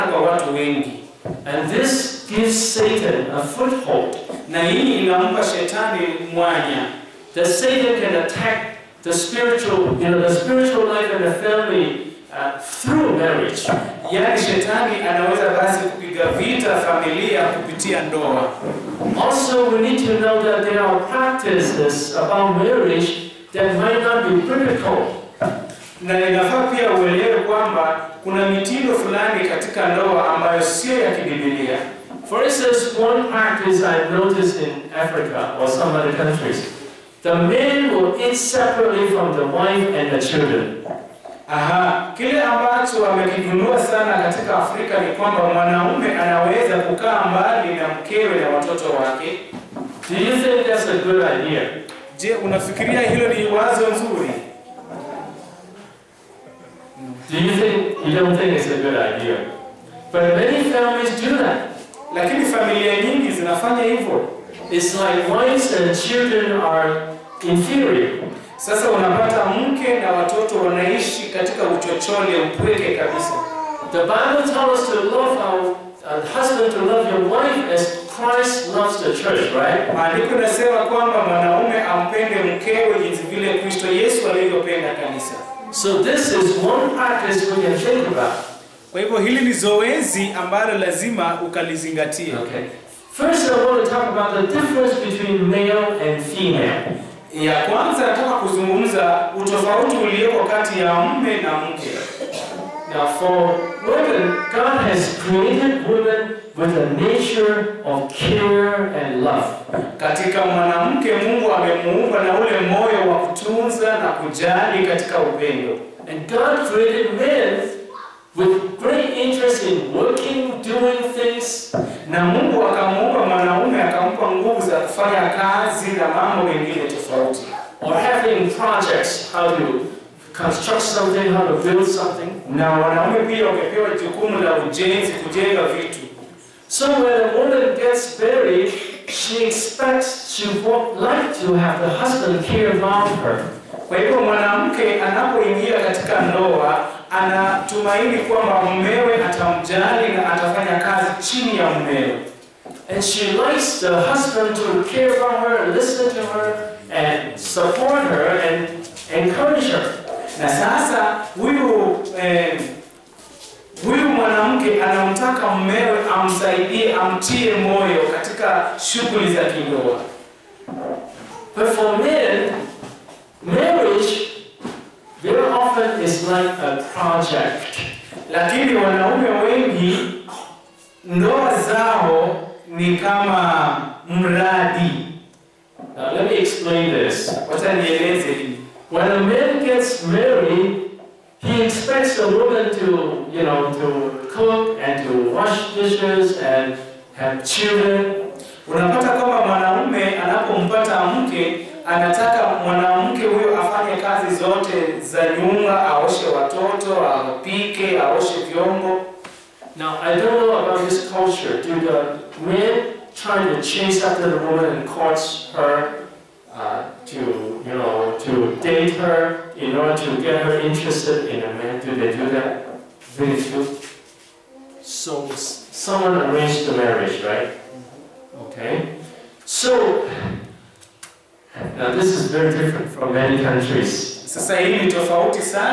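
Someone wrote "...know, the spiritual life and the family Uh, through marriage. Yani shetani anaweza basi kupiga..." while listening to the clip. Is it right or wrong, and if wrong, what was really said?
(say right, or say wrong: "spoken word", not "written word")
right.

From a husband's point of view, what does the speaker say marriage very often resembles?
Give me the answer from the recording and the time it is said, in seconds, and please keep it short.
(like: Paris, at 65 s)
A project, at 176 s.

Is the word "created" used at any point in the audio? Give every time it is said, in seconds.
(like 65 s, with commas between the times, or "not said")
105 s, 116 s.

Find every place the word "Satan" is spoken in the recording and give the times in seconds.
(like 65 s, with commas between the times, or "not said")
2 s, 7 s.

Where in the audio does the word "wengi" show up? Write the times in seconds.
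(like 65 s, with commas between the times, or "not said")
0 s, 179 s.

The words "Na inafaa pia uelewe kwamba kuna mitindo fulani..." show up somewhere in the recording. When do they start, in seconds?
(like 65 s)
26 s.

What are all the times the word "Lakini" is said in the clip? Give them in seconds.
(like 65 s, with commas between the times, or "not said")
62 s, 178 s.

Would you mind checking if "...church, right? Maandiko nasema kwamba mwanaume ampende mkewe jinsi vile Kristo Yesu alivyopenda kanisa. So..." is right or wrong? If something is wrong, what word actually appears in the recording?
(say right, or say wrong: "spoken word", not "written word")
right.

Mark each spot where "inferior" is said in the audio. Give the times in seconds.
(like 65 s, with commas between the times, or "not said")
67 s.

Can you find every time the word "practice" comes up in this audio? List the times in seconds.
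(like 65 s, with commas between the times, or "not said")
21 s, 33 s, 86 s.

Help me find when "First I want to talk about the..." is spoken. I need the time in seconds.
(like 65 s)
93 s.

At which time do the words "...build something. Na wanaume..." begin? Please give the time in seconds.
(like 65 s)
131 s.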